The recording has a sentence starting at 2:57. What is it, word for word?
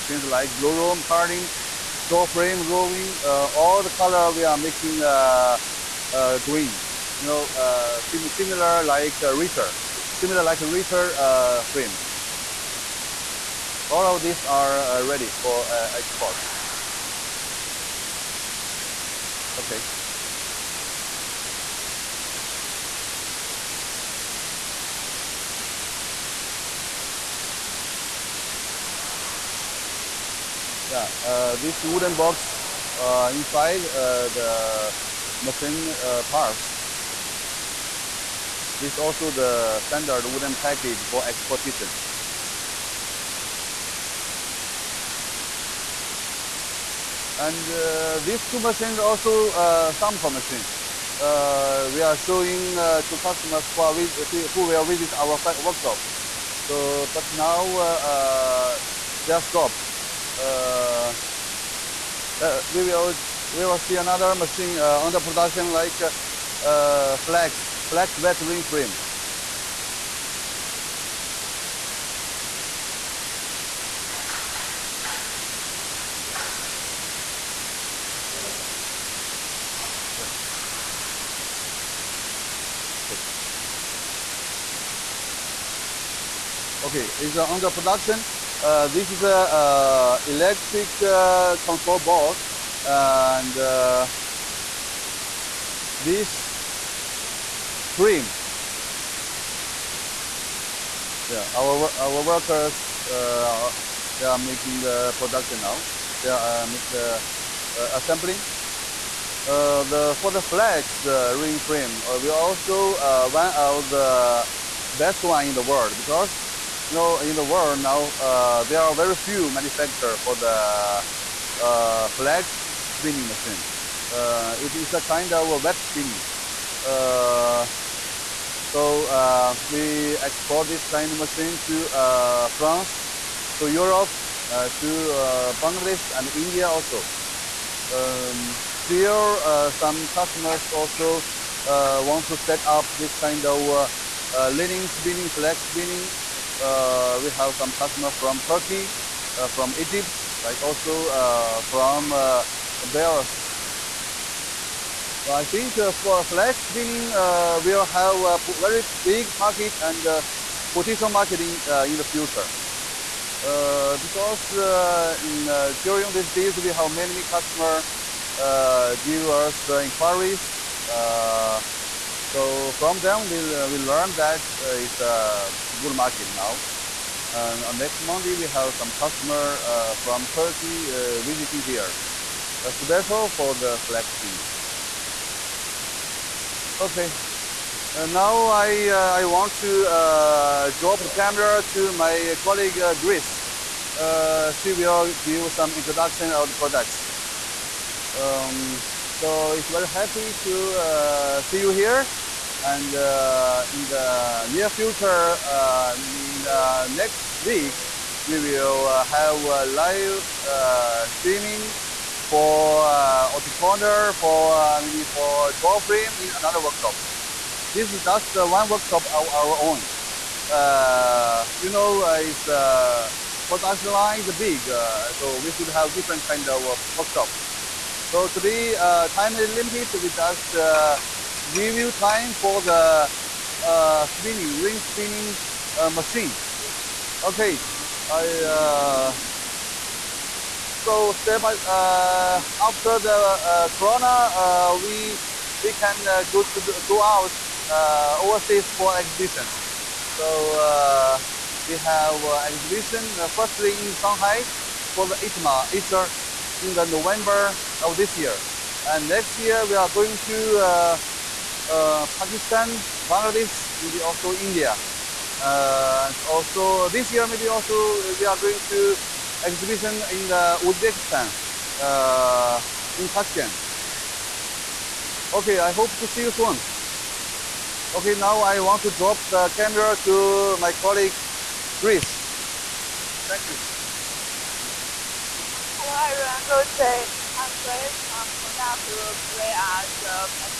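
And on next Monday, we have some customer uh, from Turkey visiting here, a special for the flax spinning.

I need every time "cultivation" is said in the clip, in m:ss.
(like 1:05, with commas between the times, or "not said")
not said.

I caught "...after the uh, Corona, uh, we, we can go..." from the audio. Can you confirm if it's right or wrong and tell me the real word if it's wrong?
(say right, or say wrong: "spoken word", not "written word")
right.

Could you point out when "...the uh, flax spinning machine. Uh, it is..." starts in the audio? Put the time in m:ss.
2:00.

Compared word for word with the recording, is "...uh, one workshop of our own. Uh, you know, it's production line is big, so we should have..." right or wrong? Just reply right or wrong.
right.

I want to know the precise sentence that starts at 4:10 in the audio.
So we have exhibition firstly in Shanghai for the ITMA Asia in the November of this year.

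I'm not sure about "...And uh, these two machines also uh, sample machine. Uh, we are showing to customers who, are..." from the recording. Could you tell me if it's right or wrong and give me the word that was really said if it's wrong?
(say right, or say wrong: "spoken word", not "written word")
right.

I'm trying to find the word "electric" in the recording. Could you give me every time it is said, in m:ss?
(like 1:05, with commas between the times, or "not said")
1:30.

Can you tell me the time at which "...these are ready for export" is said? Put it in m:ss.
0:14.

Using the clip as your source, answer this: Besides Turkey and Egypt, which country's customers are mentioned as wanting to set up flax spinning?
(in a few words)
Belarus.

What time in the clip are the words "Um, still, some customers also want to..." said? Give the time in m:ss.
2:17.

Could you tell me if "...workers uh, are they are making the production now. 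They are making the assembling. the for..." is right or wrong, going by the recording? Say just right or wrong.
right.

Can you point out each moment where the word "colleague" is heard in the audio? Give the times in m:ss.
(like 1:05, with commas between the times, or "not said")
3:12, 4:40.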